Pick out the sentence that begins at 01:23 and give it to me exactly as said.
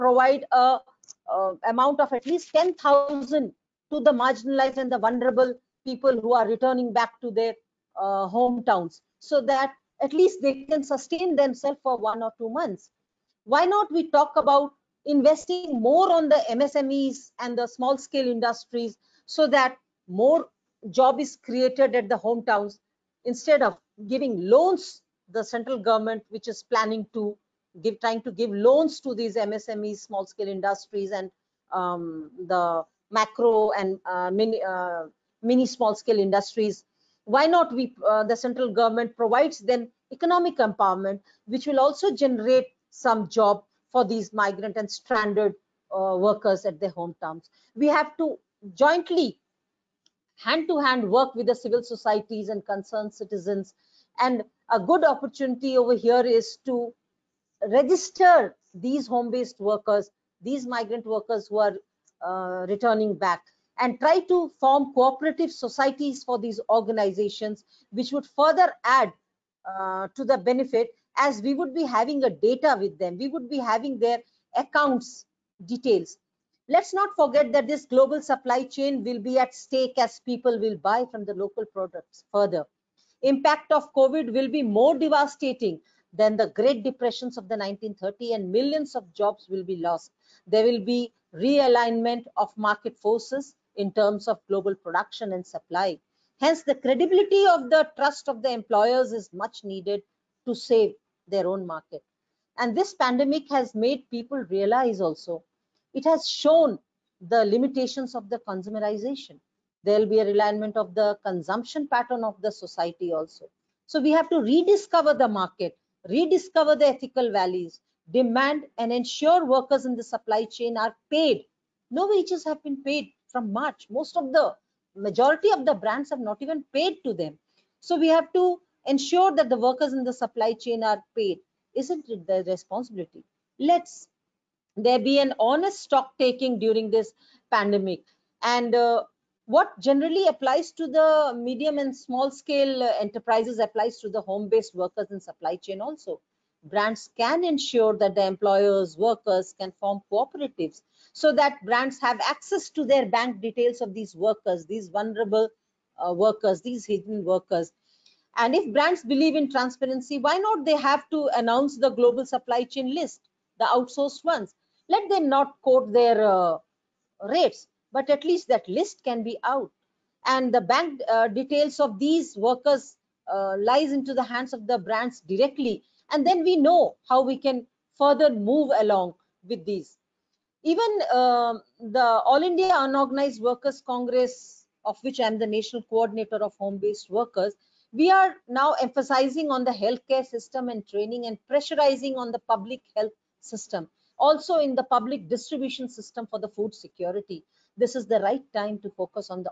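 Impact of COVID will be more devastating than the great depressions of the 1930s, and millions of jobs will be lost.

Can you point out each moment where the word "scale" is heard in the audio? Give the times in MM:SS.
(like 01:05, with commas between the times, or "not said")
00:17, 00:30, 00:35, 02:22.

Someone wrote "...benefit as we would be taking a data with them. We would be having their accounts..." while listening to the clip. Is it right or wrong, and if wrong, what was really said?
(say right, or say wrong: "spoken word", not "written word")
wrong: "having", not "taking".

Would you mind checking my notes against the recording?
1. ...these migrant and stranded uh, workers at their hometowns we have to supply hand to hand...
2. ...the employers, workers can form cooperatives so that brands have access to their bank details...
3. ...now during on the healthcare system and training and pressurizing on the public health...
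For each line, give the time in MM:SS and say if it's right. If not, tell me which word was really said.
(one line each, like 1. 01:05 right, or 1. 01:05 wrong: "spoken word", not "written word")
1. 00:44 wrong: "jointly", not "supply"
2. 02:28 right
3. 03:08 wrong: "emphasizing", not "during".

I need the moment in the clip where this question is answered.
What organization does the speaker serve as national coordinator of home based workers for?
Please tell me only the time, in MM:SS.
03:02.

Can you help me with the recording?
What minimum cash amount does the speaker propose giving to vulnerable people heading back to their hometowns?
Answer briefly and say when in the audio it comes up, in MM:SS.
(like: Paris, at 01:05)
10000, at 00:02.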